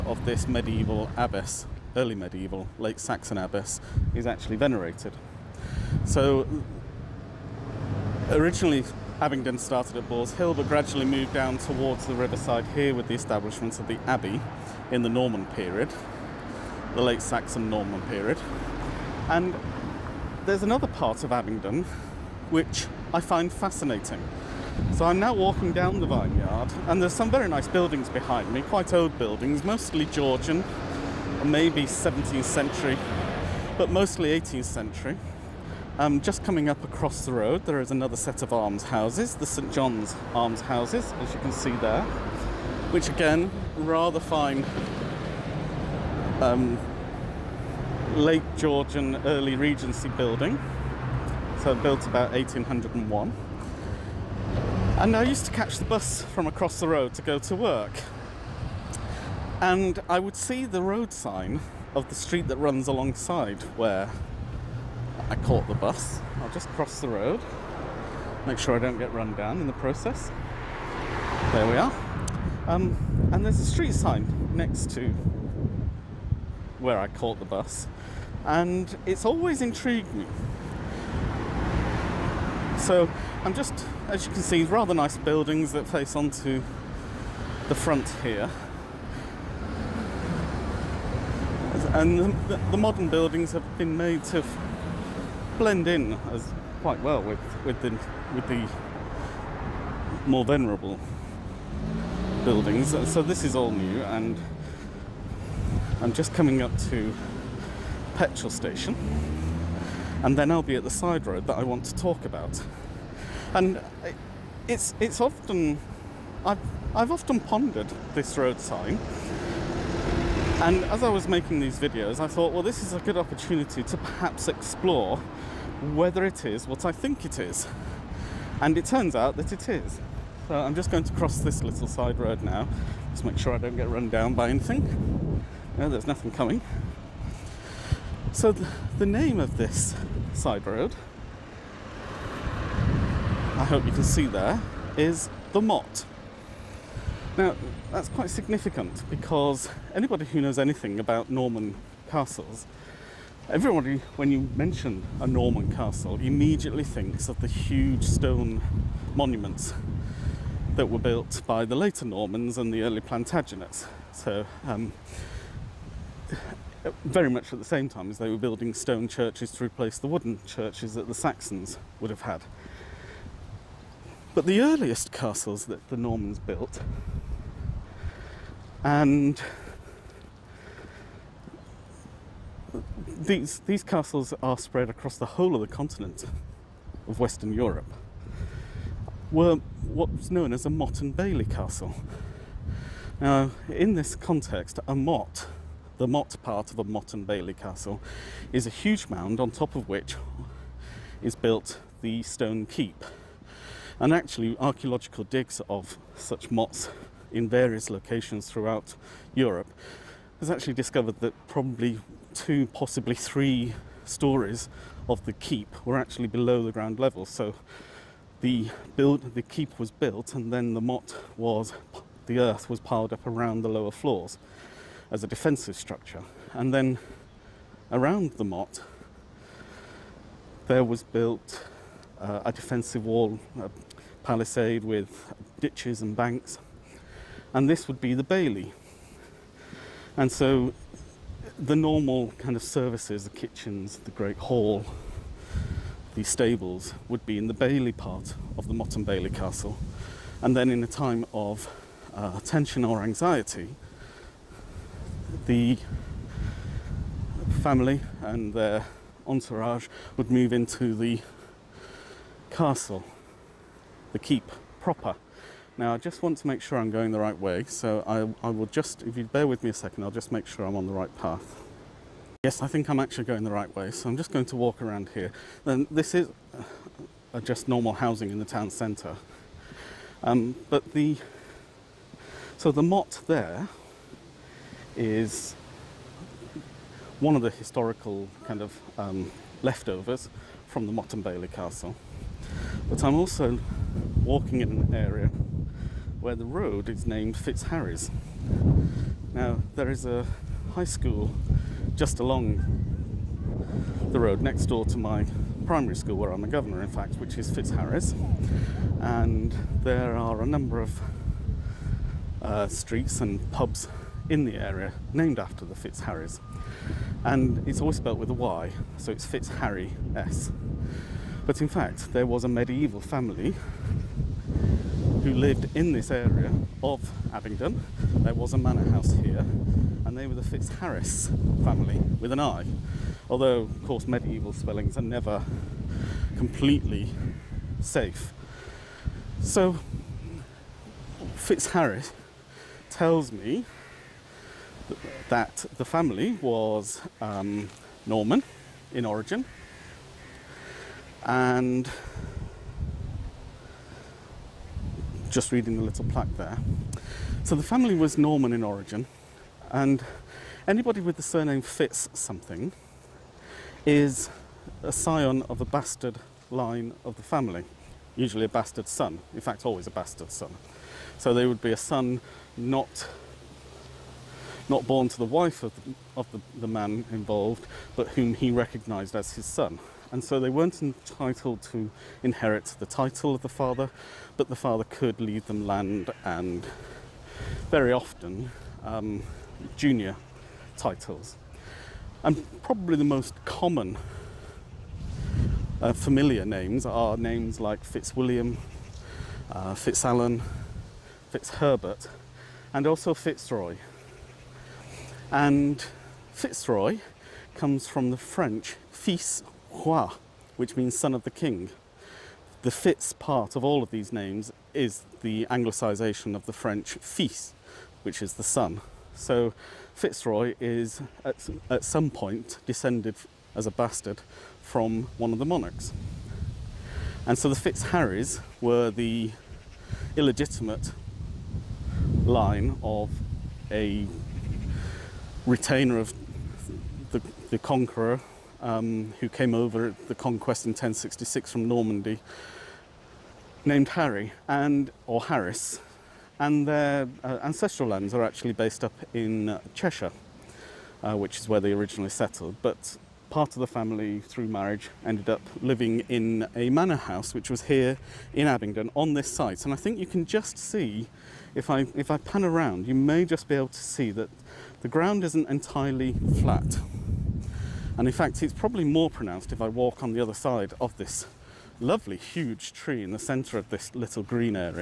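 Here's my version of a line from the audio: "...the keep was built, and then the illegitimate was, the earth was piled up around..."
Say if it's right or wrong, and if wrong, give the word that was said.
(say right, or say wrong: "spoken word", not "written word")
wrong: "motte", not "illegitimate".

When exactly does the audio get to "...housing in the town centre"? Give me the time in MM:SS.
04:37.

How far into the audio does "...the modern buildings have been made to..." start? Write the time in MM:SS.
01:32.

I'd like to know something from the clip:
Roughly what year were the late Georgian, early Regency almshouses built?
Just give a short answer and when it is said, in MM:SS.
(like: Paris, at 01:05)
1801, at 00:52.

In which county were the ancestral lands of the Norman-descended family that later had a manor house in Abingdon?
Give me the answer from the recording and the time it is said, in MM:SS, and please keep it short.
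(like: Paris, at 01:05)
Cheshire, at 07:29.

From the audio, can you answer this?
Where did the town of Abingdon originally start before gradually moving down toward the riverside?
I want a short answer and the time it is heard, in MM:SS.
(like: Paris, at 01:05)
Boars Hill, at 00:10.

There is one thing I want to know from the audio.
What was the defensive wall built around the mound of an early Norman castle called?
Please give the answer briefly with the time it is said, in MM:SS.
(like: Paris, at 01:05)
a palisade, at 03:53.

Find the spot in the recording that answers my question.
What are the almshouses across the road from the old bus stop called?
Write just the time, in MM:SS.
00:39.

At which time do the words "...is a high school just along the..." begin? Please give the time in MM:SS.
04:59.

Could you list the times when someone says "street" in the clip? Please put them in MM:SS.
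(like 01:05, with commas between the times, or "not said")
01:02, 01:13, 05:12.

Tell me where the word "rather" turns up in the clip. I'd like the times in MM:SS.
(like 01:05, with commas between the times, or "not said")
00:43, 01:24.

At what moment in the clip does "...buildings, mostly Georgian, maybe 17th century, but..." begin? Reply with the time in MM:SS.
00:29.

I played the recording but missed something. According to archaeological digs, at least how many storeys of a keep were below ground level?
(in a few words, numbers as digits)
2.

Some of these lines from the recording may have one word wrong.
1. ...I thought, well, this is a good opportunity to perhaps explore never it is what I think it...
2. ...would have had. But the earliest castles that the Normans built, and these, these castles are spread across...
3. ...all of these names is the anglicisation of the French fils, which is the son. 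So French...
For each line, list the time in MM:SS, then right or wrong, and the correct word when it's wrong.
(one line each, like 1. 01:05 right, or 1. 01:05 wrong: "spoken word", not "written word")
1. 02:02 wrong: "whether", not "never"
2. 02:51 right
3. 06:53 wrong: "Fitzroy", not "French".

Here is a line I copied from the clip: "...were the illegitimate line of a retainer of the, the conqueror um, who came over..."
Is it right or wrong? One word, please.
right.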